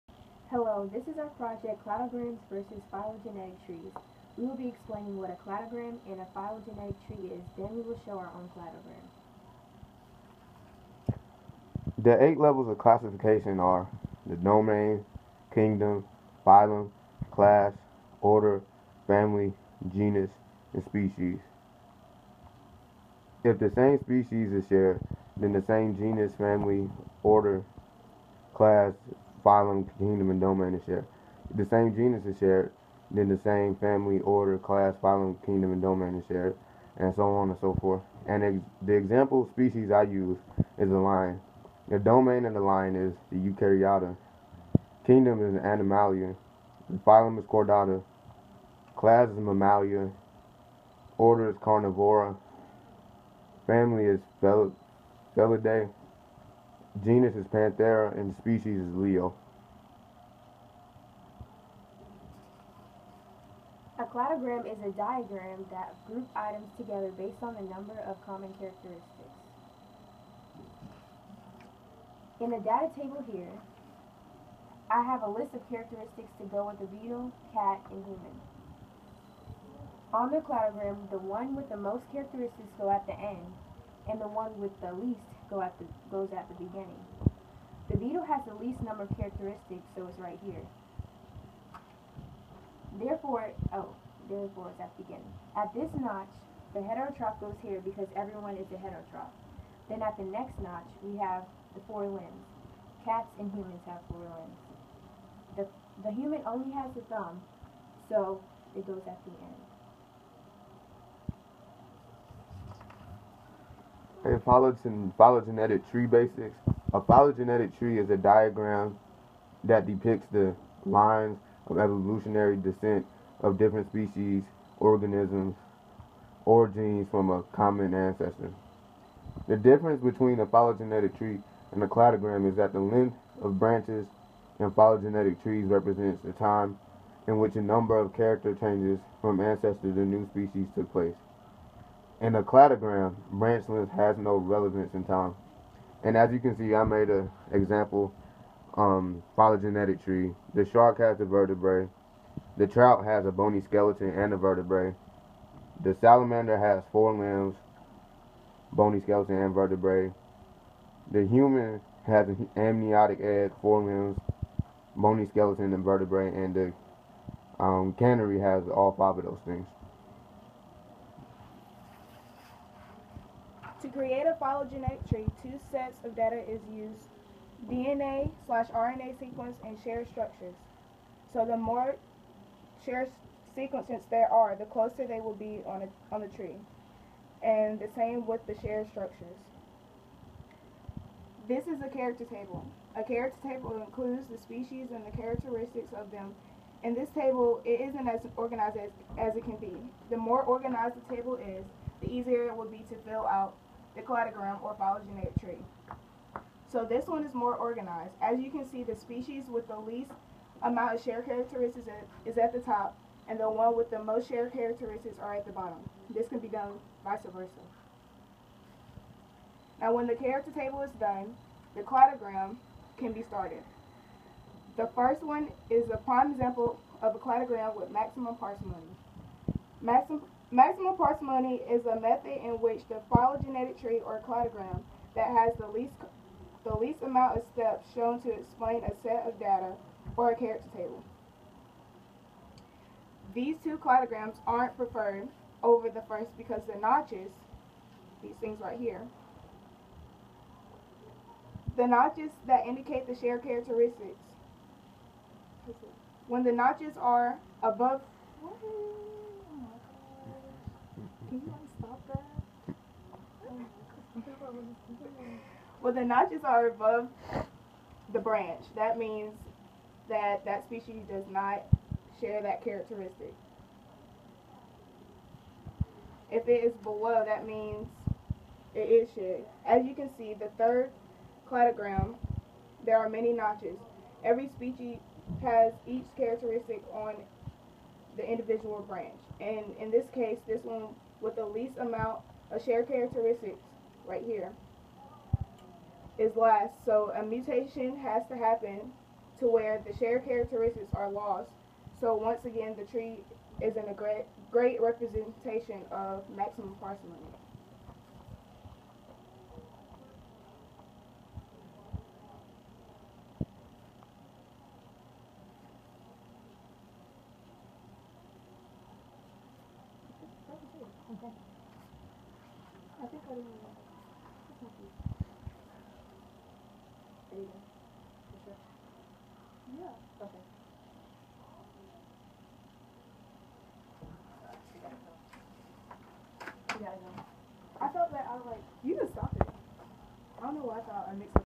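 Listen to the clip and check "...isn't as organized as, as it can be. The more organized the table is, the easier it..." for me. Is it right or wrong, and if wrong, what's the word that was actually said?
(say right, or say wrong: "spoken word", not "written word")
right.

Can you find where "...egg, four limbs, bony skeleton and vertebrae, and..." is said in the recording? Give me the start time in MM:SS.
02:43.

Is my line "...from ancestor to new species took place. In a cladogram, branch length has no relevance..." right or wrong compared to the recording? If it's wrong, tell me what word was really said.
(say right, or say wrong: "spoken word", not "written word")
right.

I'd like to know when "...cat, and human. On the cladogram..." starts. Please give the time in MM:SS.
01:17.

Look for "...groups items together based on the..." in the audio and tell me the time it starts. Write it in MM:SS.
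01:06.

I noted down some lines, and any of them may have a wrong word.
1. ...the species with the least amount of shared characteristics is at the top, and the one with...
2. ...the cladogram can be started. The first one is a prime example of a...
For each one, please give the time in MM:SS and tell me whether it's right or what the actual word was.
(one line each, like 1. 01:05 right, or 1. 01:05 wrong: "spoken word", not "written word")
1. 03:28 right
2. 03:41 right.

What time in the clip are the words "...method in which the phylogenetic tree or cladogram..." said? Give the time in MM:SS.
03:51.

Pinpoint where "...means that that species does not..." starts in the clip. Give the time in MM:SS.
04:28.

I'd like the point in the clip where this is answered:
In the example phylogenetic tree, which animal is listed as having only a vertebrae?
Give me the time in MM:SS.
02:30.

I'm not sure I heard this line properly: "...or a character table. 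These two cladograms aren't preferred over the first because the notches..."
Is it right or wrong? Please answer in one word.
right.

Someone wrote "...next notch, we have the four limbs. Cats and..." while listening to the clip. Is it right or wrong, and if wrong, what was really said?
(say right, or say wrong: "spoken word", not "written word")
right.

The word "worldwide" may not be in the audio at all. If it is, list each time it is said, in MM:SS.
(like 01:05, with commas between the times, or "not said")
not said.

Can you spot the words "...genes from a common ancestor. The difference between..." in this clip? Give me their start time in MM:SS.
02:06.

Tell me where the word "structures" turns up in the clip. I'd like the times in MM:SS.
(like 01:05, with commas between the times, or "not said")
03:00, 03:08.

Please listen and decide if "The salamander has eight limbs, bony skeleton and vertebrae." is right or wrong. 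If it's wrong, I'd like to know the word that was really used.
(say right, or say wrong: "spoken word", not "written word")
wrong: "four", not "eight".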